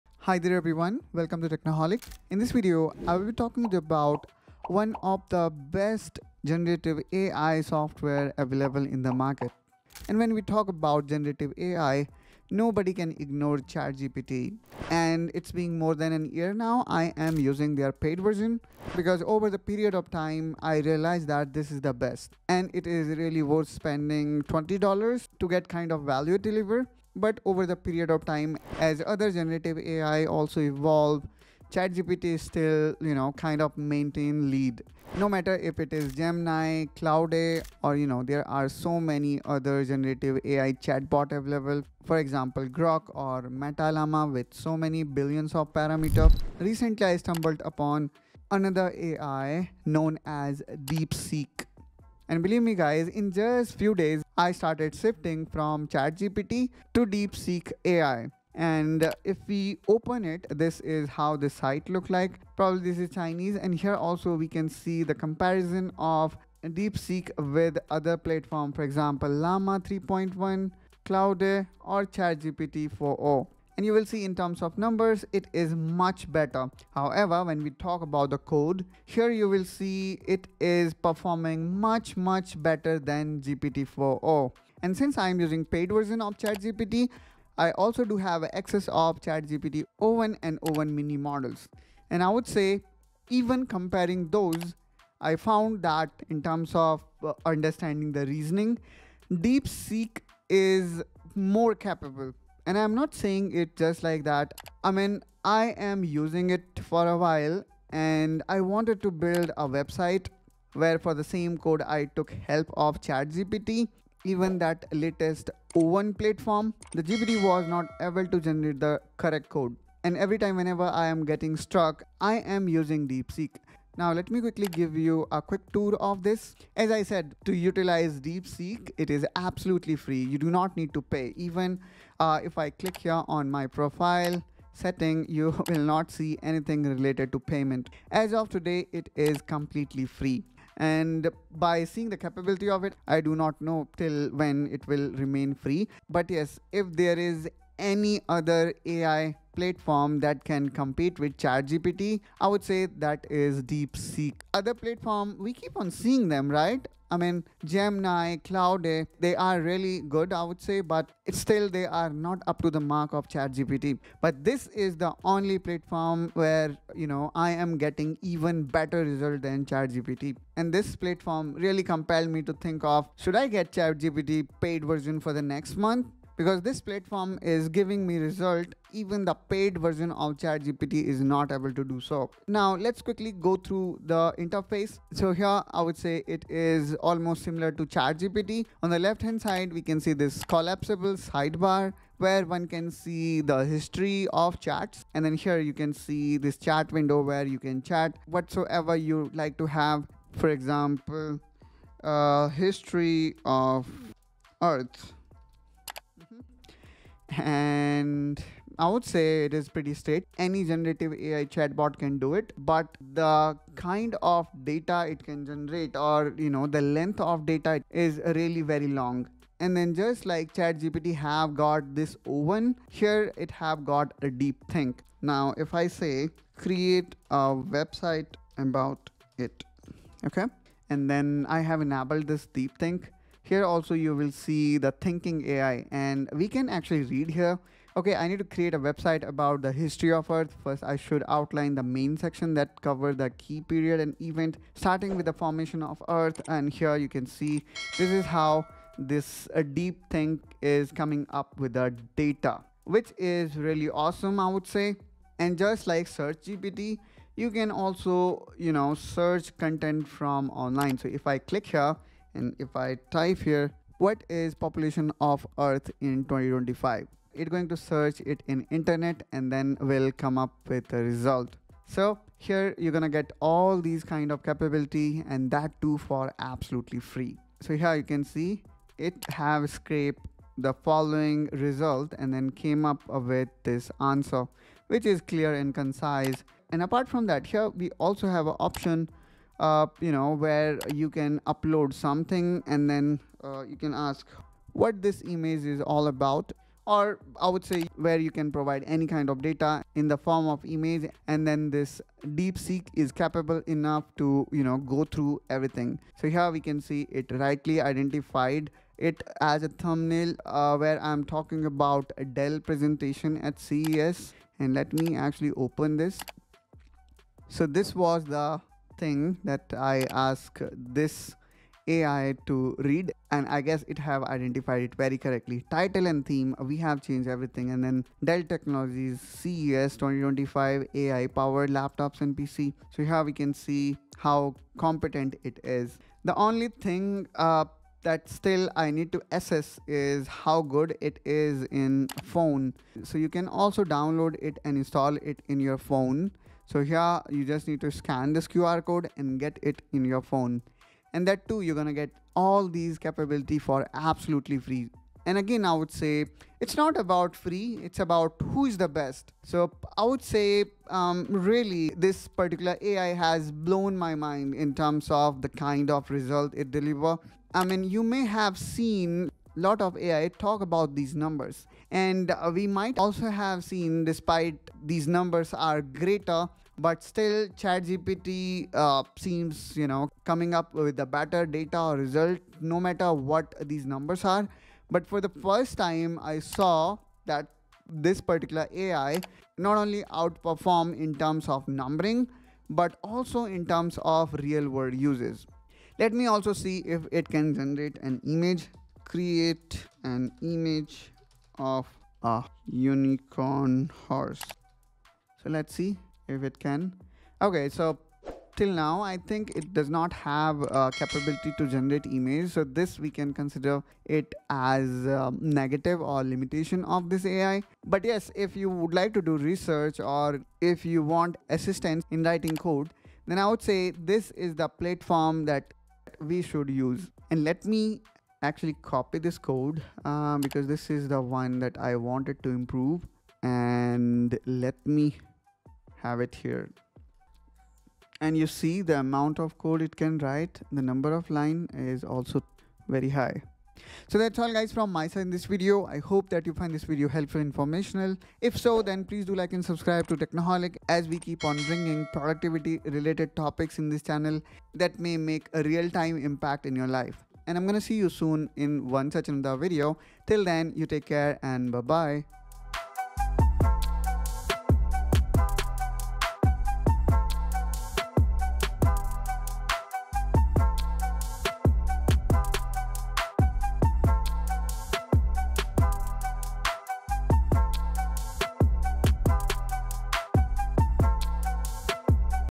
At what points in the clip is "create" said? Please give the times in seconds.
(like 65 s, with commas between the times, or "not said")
226 s, 238 s, 399 s.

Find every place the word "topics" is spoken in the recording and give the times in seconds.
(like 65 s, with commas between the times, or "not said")
453 s.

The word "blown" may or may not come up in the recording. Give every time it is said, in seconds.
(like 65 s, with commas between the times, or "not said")
363 s.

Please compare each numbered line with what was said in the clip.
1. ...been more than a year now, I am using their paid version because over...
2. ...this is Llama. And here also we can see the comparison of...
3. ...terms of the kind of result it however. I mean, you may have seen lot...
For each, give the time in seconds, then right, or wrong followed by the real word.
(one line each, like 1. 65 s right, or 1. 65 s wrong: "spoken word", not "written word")
1. 15 s right
2. 62 s wrong: "Chinese", not "Llama"
3. 364 s wrong: "deliver", not "however".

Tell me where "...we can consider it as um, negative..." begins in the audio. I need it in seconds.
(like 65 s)
412 s.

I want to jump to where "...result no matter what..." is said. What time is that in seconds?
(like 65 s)
381 s.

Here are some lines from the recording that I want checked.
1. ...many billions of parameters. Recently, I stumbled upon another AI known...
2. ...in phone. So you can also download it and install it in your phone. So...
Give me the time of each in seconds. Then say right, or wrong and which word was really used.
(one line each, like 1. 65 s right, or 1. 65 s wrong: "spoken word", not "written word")
1. 44 s right
2. 341 s right.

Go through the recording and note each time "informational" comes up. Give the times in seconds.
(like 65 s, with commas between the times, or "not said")
447 s.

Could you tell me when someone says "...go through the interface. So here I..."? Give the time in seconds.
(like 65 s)
183 s.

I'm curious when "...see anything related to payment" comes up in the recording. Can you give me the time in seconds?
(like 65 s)
136 s.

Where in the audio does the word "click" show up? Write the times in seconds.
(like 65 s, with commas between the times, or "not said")
132 s, 261 s.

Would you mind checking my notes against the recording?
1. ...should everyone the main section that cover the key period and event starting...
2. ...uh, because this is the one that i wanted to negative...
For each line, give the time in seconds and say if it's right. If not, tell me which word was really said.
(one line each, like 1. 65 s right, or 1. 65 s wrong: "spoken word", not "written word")
1. 240 s wrong: "outline", not "everyone"
2. 430 s wrong: "improve", not "negative".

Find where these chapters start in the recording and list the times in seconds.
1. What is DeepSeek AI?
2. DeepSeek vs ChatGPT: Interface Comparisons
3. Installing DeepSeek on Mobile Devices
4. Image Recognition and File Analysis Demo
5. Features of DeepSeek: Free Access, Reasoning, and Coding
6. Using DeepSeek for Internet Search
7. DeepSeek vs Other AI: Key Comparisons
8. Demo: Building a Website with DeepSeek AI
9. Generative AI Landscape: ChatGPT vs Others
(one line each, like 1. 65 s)
1. 47 s
2. 183 s
3. 336 s
4. 287 s
5. 85 s
6. 257 s
7. 65 s
8. 105 s
9. 10 s.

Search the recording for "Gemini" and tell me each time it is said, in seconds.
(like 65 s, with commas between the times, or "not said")
36 s, 157 s.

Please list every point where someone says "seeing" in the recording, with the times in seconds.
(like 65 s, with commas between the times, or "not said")
141 s, 155 s.